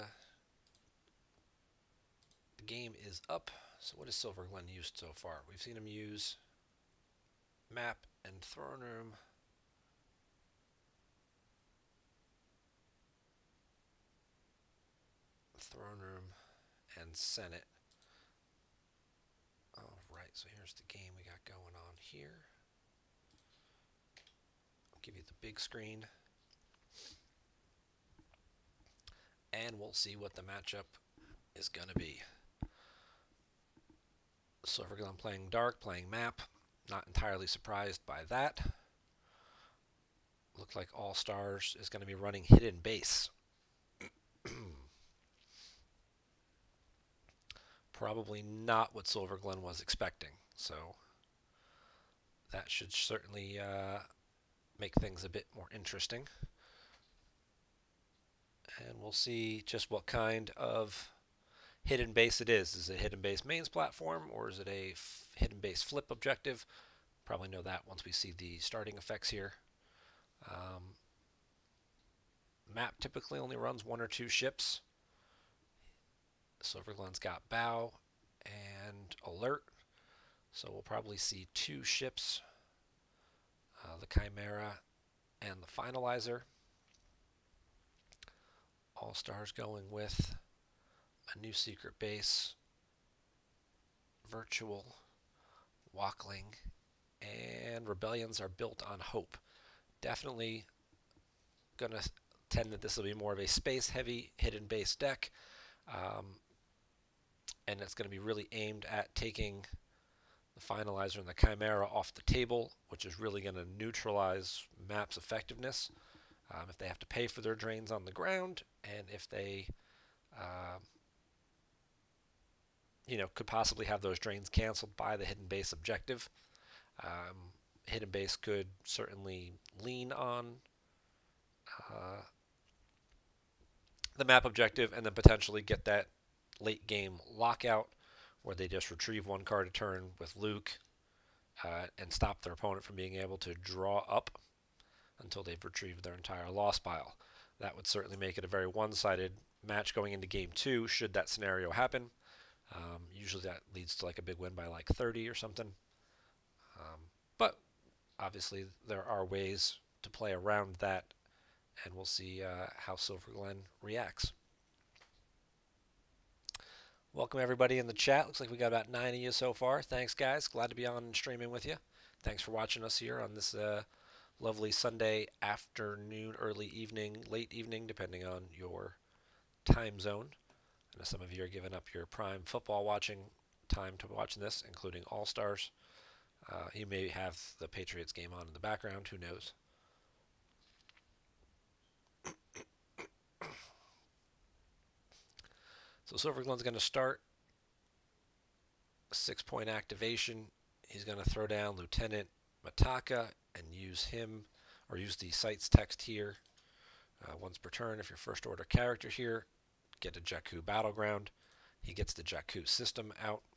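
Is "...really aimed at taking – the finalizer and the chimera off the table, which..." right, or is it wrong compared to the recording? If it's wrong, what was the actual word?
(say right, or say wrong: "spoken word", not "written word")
right.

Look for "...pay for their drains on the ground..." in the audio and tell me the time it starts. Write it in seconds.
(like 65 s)
117 s.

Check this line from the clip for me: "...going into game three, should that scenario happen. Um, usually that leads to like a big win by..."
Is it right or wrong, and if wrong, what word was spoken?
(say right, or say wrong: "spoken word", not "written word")
wrong: "two", not "three".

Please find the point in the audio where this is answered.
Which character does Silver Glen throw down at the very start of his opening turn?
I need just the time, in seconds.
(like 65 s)
201 s.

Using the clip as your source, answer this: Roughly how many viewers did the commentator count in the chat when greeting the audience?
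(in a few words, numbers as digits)
9.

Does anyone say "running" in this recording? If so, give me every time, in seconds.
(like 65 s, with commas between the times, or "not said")
42 s.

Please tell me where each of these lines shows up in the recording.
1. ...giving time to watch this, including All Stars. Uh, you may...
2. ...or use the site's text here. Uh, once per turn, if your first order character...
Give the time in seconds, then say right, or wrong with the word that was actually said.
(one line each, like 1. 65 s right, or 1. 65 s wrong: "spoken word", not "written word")
1. 182 s wrong: "watching", not "giving"
2. 204 s right.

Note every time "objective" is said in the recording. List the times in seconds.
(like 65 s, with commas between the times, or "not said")
66 s, 125 s, 134 s.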